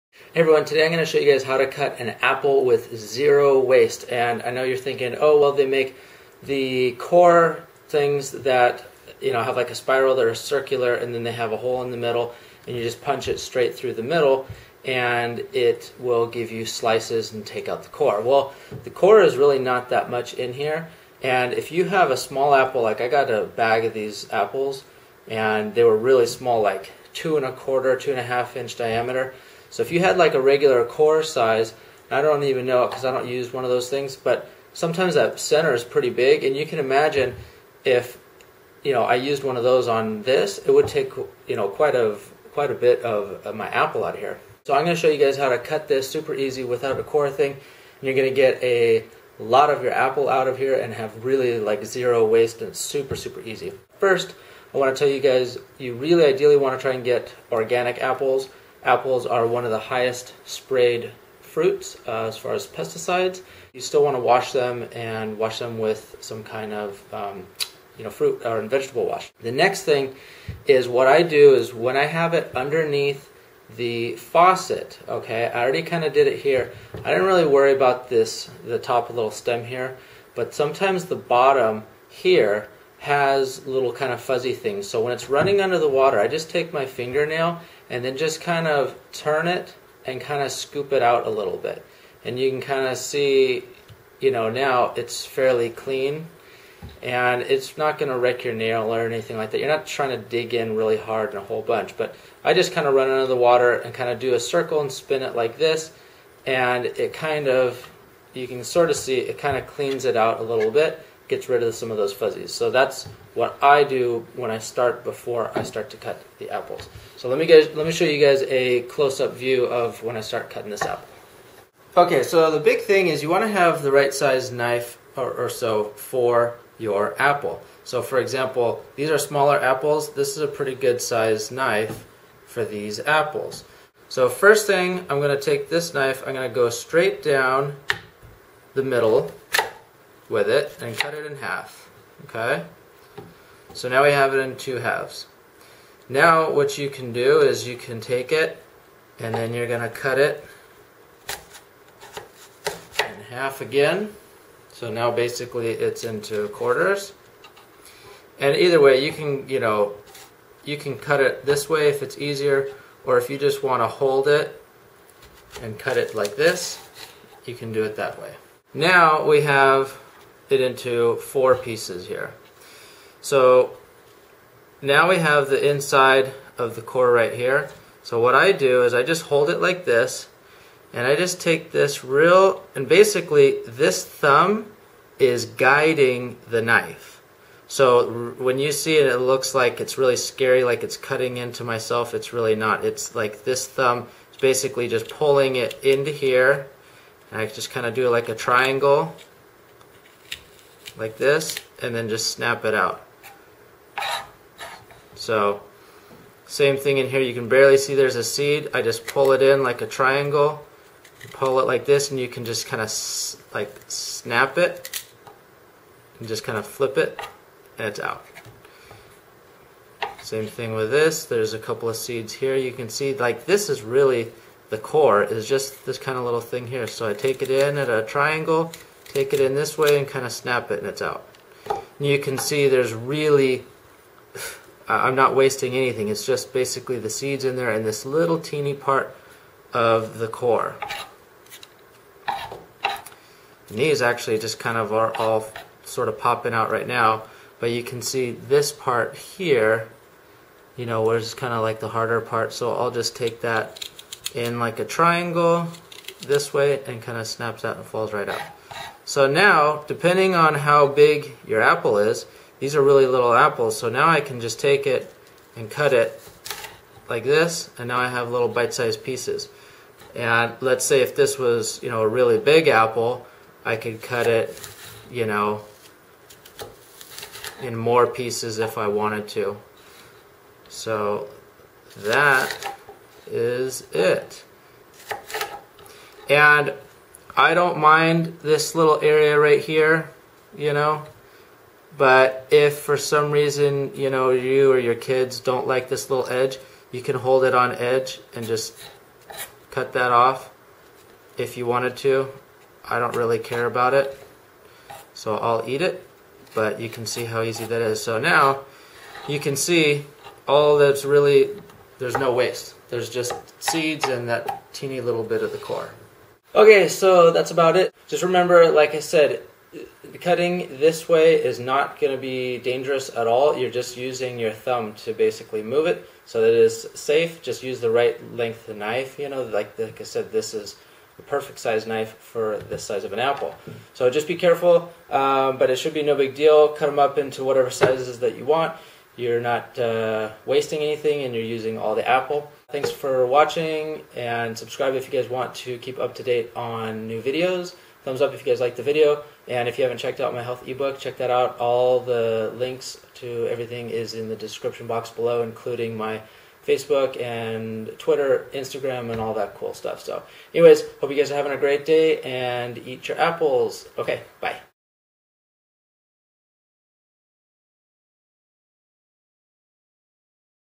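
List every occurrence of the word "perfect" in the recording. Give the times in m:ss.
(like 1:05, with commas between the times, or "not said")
5:31.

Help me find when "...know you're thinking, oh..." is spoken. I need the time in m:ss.
0:04.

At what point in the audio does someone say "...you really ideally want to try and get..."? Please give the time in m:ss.
0:55.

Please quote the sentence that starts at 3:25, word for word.
So same thing in here, you can barely see there's a seed.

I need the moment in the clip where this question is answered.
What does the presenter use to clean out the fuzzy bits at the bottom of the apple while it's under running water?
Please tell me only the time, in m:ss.
1:26.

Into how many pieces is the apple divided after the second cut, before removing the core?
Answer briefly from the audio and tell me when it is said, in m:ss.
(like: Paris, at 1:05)
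4, at 2:51.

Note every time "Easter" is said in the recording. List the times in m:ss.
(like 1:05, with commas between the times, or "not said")
not said.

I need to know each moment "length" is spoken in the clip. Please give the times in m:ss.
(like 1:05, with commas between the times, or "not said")
5:28.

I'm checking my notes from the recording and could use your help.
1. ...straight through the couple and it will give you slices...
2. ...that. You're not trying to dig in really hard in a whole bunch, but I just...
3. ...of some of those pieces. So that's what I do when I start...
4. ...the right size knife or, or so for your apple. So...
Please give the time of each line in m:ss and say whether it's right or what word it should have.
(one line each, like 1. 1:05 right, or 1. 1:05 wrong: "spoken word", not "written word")
1. 0:13 wrong: "middle", not "couple"
2. 1:39 right
3. 1:51 wrong: "fuzzies", not "pieces"
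4. 2:03 right.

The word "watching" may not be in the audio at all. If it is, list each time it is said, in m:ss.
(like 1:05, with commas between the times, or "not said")
5:43.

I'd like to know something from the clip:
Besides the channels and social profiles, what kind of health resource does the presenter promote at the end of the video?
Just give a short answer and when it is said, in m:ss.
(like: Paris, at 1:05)
health ebook, at 5:50.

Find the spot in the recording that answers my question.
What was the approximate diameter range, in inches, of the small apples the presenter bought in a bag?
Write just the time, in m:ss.
0:27.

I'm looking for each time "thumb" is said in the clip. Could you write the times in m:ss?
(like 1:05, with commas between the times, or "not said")
3:04, 3:13, 5:24, 5:48.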